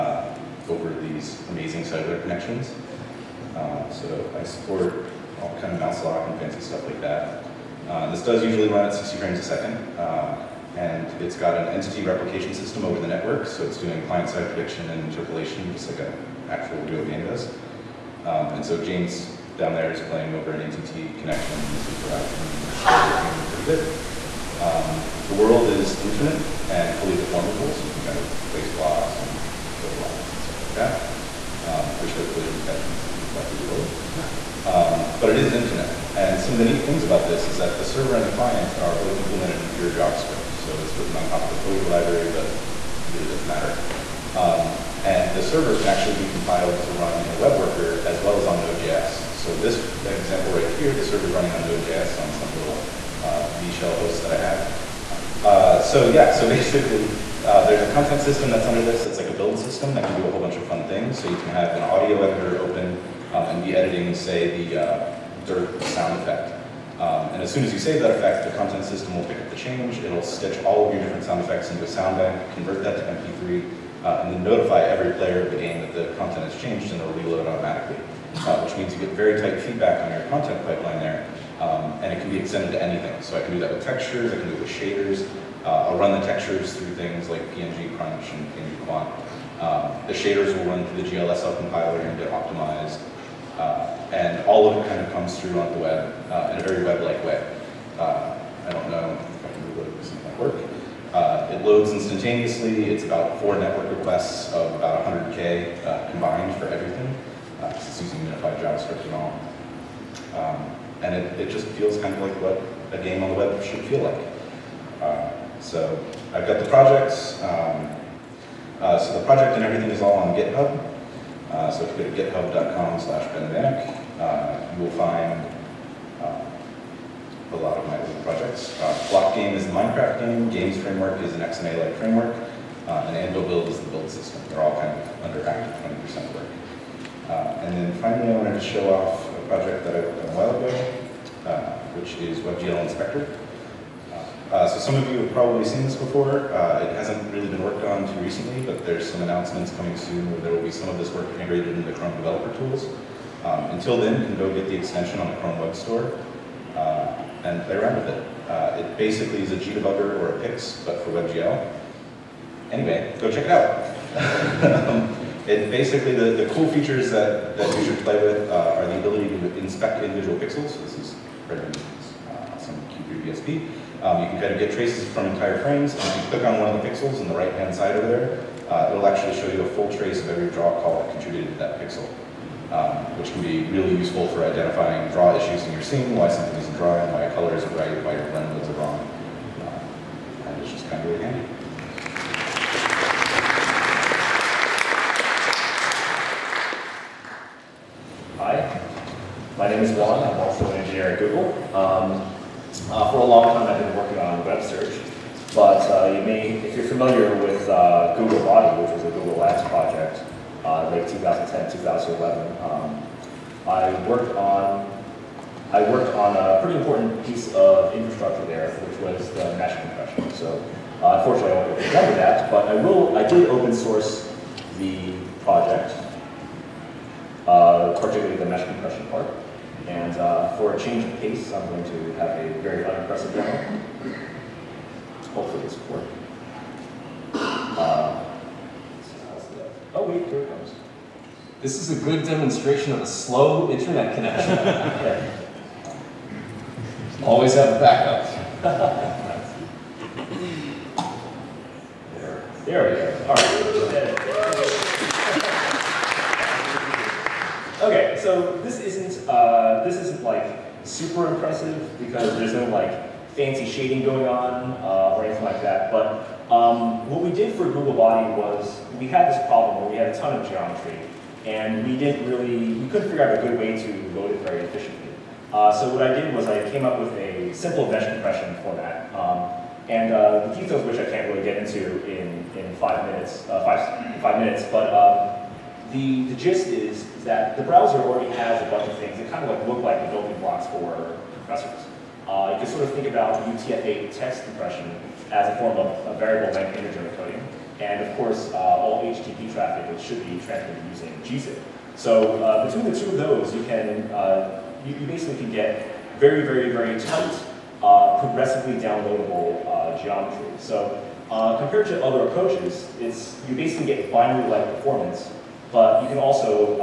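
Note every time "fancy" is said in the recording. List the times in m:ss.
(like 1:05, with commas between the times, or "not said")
0:06, 4:23.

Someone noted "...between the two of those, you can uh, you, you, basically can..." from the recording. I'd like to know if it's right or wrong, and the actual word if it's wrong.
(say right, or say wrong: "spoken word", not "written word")
right.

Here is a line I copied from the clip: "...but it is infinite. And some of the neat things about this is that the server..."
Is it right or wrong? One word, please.
right.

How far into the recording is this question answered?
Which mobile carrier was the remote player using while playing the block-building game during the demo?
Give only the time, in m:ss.
0:21.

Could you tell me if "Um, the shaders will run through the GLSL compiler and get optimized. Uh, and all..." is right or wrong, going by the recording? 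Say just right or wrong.
right.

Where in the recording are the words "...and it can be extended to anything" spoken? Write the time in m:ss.
1:22.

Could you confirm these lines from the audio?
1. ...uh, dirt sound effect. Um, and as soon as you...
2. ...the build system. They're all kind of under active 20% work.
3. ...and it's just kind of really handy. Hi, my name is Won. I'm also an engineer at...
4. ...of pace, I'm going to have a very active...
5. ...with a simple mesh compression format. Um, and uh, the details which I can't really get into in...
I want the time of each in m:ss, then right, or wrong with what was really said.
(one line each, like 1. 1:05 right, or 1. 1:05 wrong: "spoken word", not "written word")
1. 1:04 right
2. 2:13 right
3. 3:10 right
4. 3:51 wrong: "unimpressive", not "active"
5. 4:36 right.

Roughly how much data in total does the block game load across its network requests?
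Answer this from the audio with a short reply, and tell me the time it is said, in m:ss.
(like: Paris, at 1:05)
100K, at 1:45.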